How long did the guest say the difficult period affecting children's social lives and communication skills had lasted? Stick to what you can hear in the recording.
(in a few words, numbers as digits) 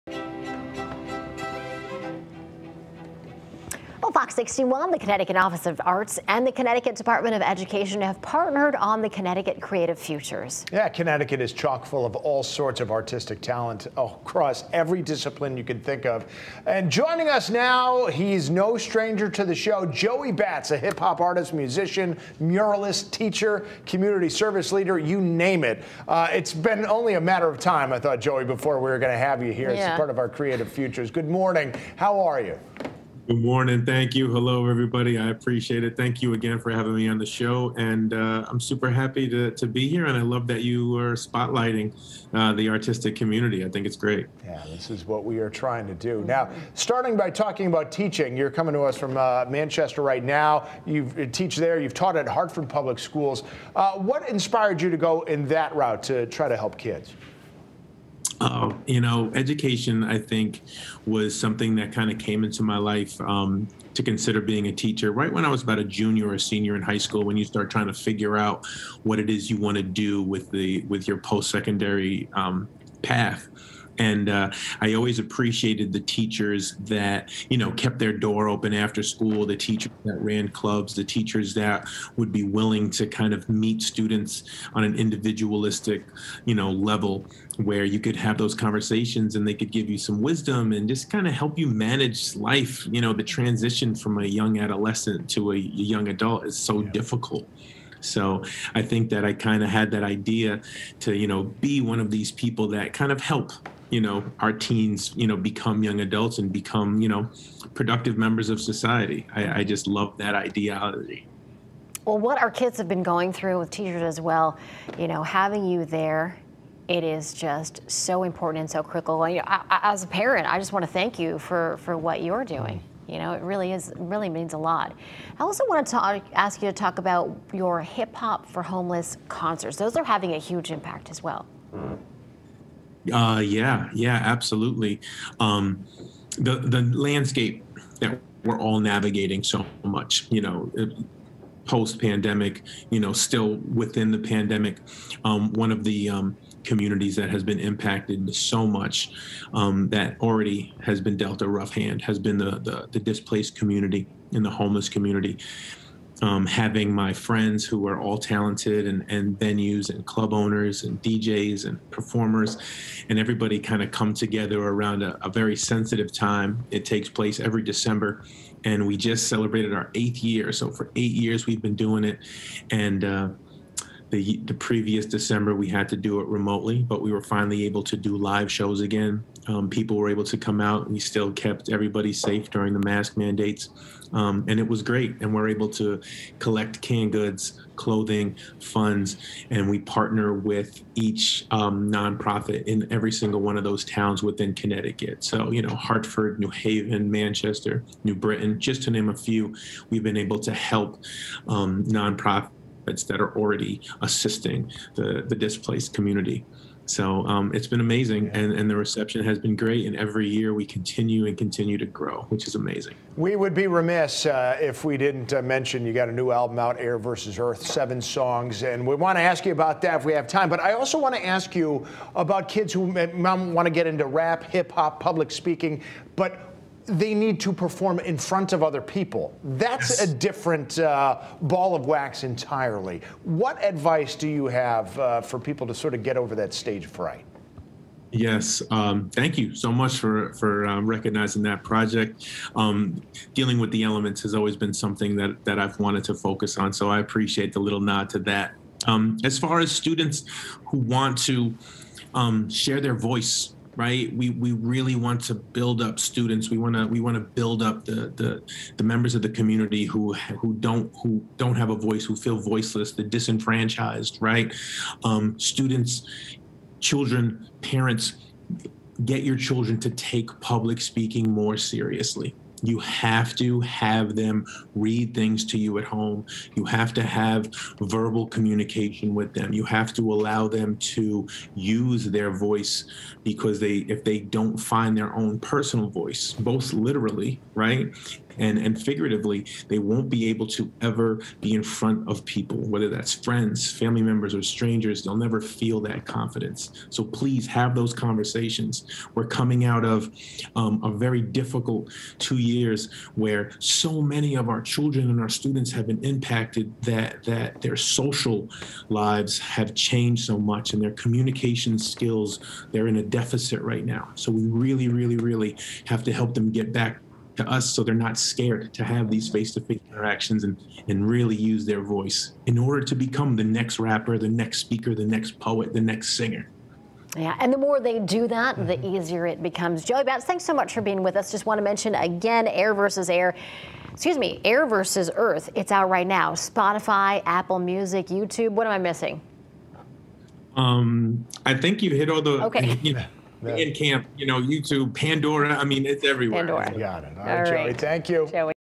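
2 years.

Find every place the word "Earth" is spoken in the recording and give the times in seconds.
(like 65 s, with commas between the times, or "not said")
217 s, 335 s.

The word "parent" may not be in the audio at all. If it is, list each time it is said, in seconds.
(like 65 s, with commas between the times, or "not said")
120 s, 267 s.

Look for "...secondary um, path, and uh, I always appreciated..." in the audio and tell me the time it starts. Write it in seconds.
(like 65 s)
71 s.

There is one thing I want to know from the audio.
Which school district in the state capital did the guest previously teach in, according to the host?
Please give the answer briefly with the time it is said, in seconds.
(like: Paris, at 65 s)
Hartford Public Schools, at 52 s.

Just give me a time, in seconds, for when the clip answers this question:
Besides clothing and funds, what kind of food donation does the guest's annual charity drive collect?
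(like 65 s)
186 s.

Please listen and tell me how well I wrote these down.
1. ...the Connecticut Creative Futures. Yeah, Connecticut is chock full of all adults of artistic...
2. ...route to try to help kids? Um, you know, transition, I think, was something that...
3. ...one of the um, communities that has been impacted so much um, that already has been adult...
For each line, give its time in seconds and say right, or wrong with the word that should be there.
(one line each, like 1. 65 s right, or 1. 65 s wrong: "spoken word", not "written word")
1. 9 s wrong: "sorts", not "adults"
2. 55 s wrong: "education", not "transition"
3. 145 s wrong: "dealt", not "adult".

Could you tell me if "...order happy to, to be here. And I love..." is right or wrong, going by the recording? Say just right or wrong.
wrong.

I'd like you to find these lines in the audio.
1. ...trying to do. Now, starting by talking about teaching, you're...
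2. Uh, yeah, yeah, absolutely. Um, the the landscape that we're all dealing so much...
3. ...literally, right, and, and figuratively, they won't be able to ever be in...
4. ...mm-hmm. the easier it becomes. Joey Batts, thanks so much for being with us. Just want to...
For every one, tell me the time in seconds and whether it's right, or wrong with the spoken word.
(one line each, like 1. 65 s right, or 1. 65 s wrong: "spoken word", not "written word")
1. 45 s right
2. 133 s wrong: "navigating", not "dealing"
3. 286 s right
4. 328 s right.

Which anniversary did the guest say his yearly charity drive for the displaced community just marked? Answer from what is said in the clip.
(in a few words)
8th year.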